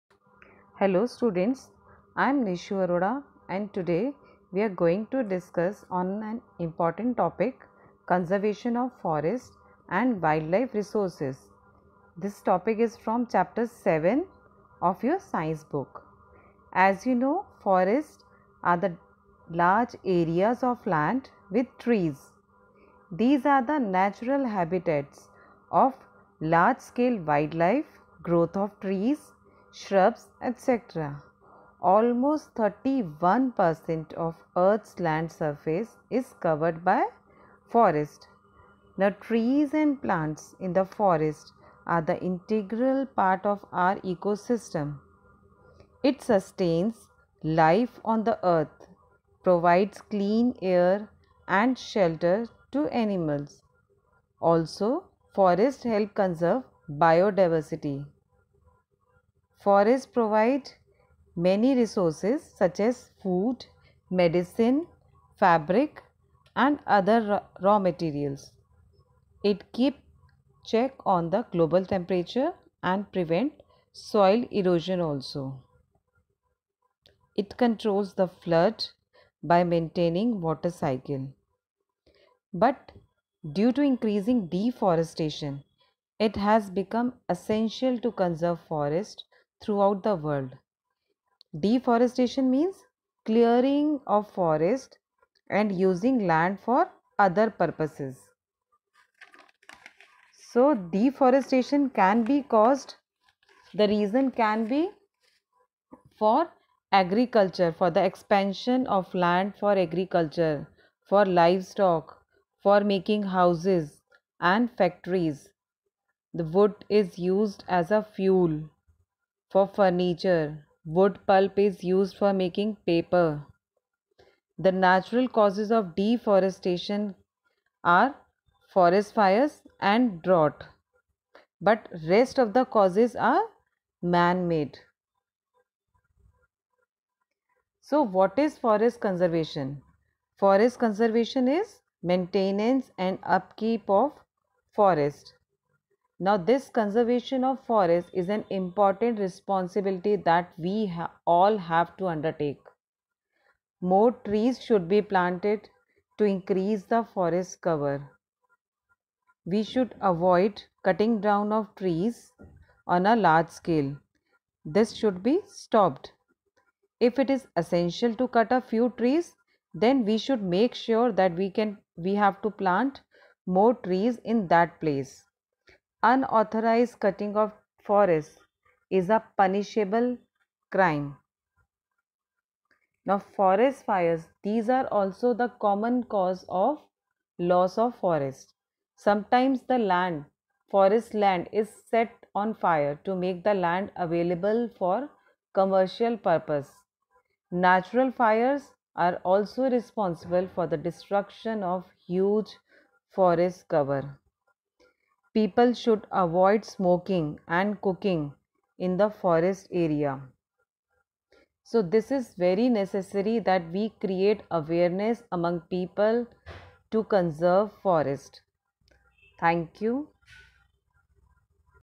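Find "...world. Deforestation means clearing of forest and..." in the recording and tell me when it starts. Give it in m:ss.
1:30.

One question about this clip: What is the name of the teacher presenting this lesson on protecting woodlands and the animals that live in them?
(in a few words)
Nishu Arora.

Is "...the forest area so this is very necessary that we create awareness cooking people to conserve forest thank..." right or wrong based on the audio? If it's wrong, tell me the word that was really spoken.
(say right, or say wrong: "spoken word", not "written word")
wrong: "among", not "cooking".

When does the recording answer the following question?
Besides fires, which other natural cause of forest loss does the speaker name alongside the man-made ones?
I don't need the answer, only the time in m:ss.
2:10.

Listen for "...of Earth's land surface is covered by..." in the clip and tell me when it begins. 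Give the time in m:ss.
0:34.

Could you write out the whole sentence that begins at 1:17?
It controls the flood by maintaining water cycle.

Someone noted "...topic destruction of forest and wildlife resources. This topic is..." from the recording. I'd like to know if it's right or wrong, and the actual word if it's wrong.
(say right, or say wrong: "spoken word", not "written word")
wrong: "conservation", not "destruction".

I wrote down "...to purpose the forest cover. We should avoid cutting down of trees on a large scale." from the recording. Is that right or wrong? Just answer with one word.
wrong.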